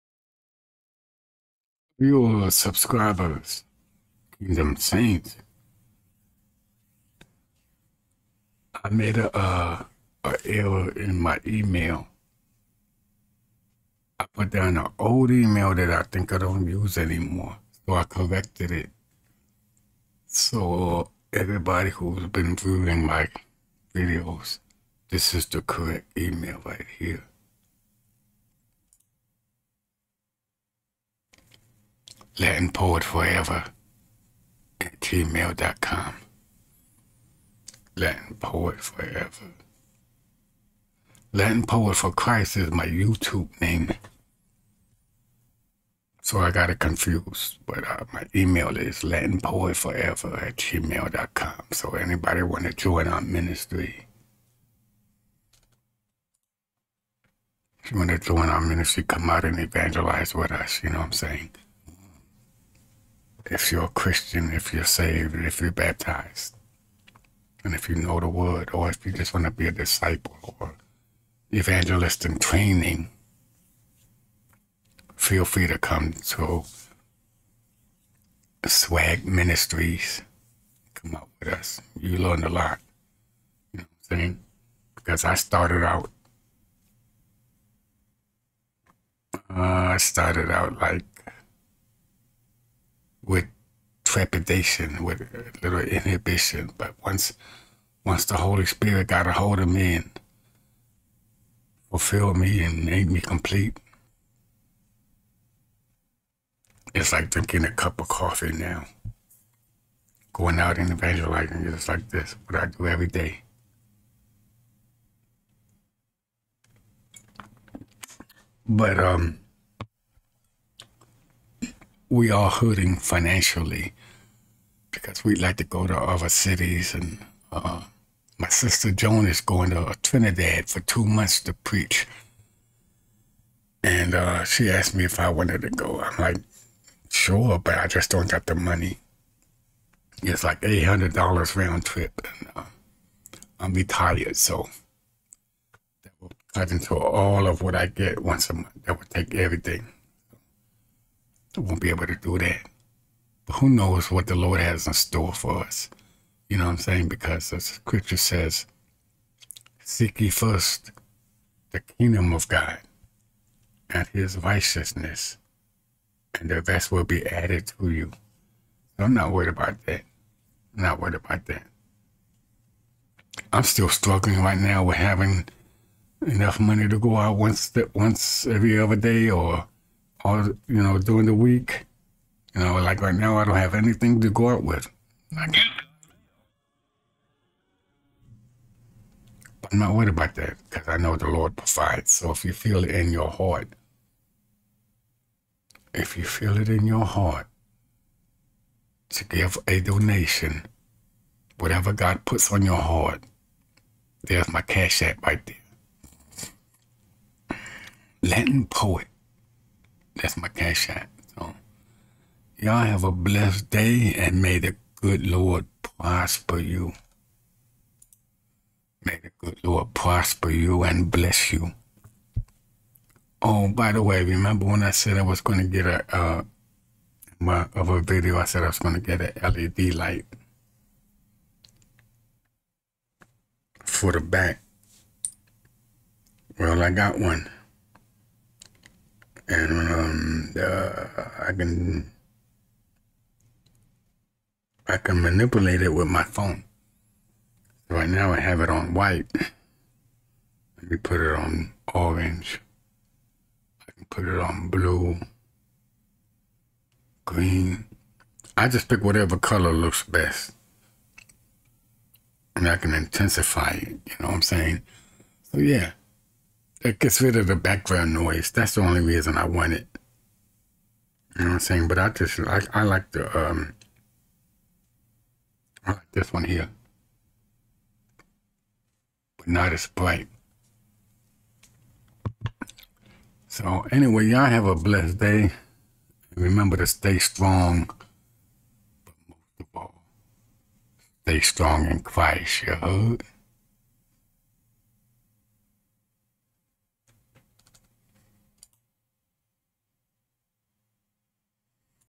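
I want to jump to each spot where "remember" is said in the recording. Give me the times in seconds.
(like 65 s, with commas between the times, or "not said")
224 s, 286 s.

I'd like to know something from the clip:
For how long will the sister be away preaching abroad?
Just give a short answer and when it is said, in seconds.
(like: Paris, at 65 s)
2 months, at 130 s.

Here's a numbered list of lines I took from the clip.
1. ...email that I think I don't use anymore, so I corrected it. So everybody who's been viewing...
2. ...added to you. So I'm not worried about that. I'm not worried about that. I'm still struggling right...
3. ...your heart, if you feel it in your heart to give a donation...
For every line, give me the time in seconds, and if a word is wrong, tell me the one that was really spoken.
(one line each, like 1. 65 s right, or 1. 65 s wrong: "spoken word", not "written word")
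1. 15 s right
2. 167 s right
3. 193 s right.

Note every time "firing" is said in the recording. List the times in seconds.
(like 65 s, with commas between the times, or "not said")
not said.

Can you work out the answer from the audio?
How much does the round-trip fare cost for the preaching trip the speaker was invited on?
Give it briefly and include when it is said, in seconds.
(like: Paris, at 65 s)
$800, at 140 s.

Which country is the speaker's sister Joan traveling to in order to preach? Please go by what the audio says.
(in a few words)
Trinidad.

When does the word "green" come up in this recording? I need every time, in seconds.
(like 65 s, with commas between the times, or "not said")
257 s.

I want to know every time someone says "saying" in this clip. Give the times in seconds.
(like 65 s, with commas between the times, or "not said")
61 s, 84 s, 156 s, 264 s, 271 s.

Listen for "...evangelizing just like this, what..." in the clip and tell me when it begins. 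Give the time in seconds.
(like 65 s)
110 s.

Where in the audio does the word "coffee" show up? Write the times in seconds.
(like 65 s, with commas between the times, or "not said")
108 s.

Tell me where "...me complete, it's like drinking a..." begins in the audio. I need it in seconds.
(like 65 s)
103 s.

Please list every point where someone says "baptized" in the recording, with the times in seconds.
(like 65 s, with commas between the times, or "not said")
65 s.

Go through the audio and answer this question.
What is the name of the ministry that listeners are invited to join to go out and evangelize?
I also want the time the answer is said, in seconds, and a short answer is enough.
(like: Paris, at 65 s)
Swag Ministries, at 78 s.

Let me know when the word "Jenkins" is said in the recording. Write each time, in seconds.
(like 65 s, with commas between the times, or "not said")
not said.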